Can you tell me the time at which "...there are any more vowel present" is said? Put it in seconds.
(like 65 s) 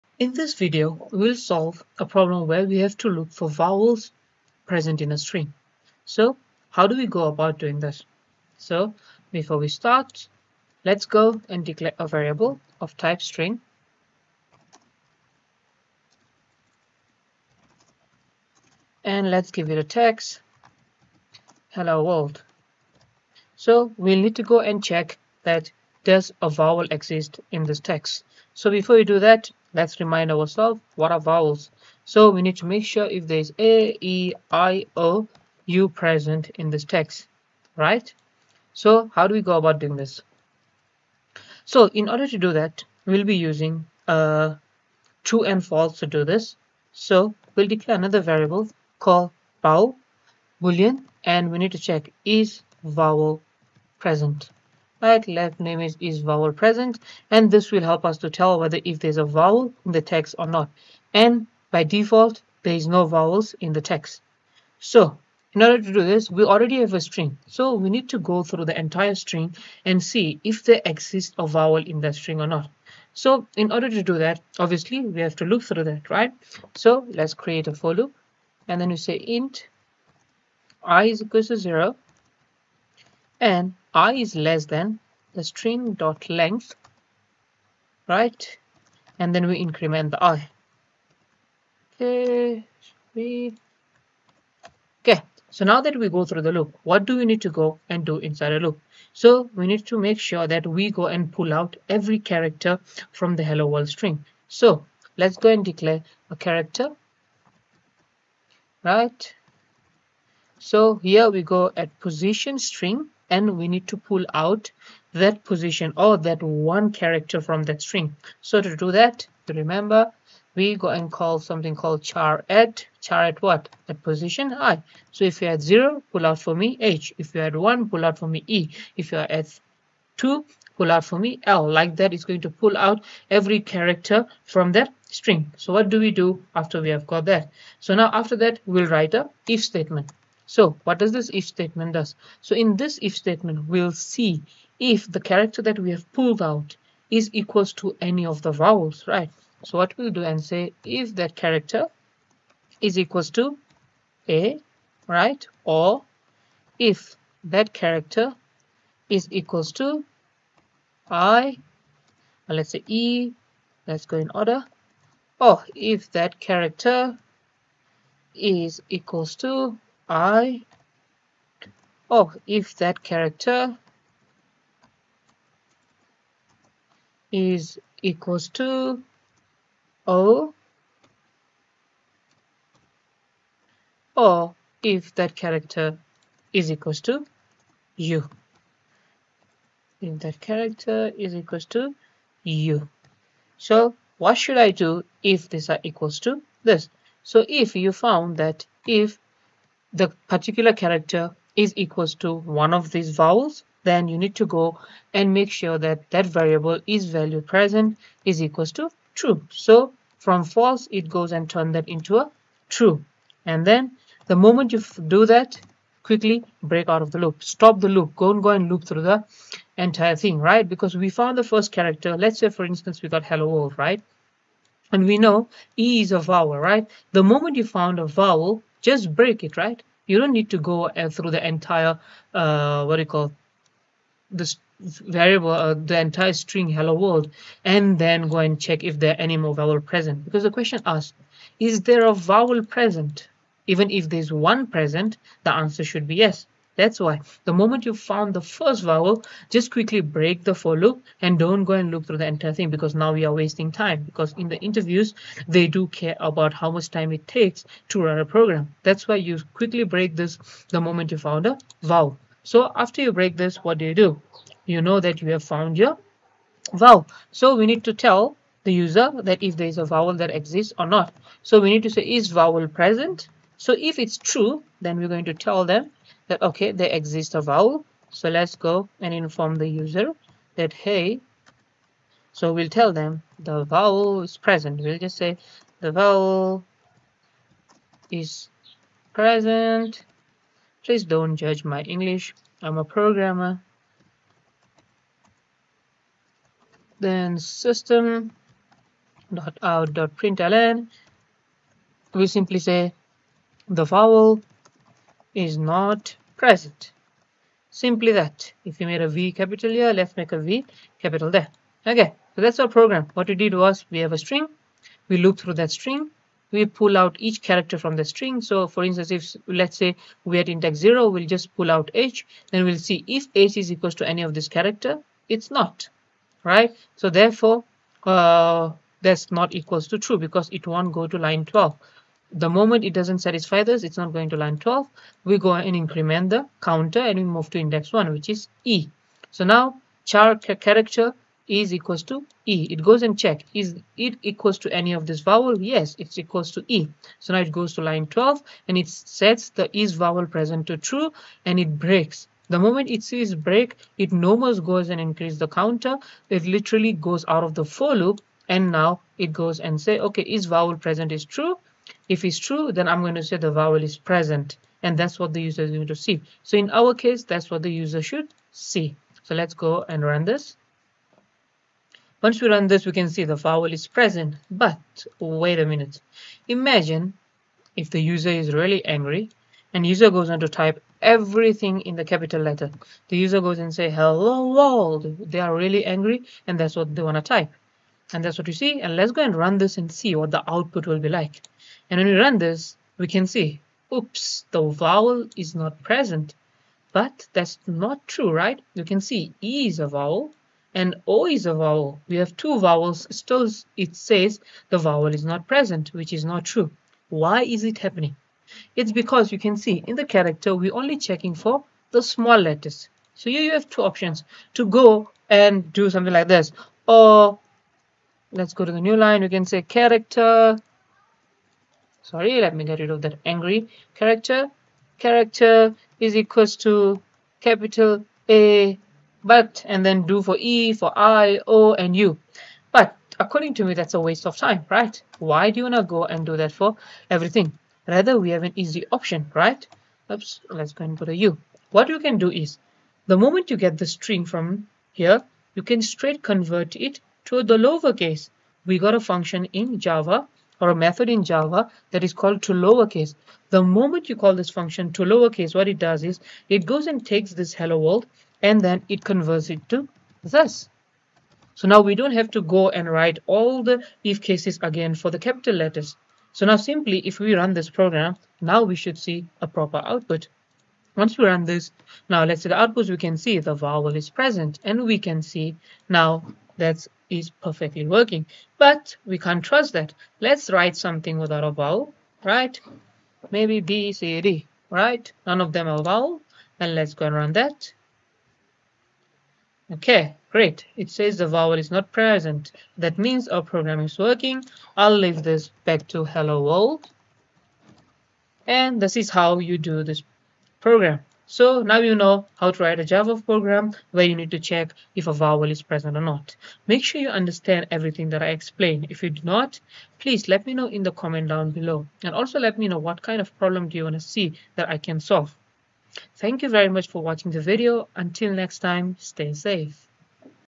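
238 s.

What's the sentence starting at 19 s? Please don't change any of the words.
And let's give it a text, hello world.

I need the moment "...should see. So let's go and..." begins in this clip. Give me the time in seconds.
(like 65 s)
368 s.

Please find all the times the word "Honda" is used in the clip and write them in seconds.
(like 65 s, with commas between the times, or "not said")
not said.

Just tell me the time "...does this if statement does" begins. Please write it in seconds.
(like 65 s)
140 s.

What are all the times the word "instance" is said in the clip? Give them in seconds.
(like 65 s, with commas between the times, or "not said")
222 s, 318 s.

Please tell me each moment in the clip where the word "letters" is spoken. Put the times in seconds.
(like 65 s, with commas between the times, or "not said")
382 s, 412 s, 465 s.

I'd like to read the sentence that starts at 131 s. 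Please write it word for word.
Like that, it's going to pull out every character from that string.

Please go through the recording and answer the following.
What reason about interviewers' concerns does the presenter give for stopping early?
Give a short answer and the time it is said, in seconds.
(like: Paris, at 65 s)
time it takes, at 256 s.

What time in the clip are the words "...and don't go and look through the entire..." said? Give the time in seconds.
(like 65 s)
251 s.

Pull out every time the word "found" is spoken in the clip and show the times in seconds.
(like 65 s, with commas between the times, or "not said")
197 s, 221 s, 227 s, 247 s, 261 s, 265 s.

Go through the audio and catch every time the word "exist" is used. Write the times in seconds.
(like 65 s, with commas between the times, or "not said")
26 s, 70 s, 270 s, 276 s.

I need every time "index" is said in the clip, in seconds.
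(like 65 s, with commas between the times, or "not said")
320 s, 337 s.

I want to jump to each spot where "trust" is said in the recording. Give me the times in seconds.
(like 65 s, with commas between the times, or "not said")
479 s.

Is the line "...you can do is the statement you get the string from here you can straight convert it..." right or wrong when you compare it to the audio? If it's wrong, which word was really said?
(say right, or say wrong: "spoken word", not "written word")
wrong: "moment", not "statement".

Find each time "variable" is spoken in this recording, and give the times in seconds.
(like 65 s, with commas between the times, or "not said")
12 s, 48 s, 206 s, 234 s.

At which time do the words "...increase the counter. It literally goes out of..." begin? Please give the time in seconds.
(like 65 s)
355 s.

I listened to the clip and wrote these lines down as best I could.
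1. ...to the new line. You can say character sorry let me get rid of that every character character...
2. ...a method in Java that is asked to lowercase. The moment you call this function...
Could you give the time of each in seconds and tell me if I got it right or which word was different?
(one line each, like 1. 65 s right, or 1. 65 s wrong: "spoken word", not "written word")
1. 418 s wrong: "angry", not "every"
2. 450 s wrong: "called", not "asked".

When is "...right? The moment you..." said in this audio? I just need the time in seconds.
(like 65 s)
226 s.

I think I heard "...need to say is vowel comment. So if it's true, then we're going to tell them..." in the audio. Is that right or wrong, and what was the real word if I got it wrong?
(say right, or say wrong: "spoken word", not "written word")
wrong: "present", not "comment".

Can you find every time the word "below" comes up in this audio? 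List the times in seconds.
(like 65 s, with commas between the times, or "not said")
511 s.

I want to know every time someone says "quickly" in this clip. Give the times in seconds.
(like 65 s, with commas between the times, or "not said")
216 s, 249 s, 259 s.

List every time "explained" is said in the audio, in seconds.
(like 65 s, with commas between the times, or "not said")
508 s.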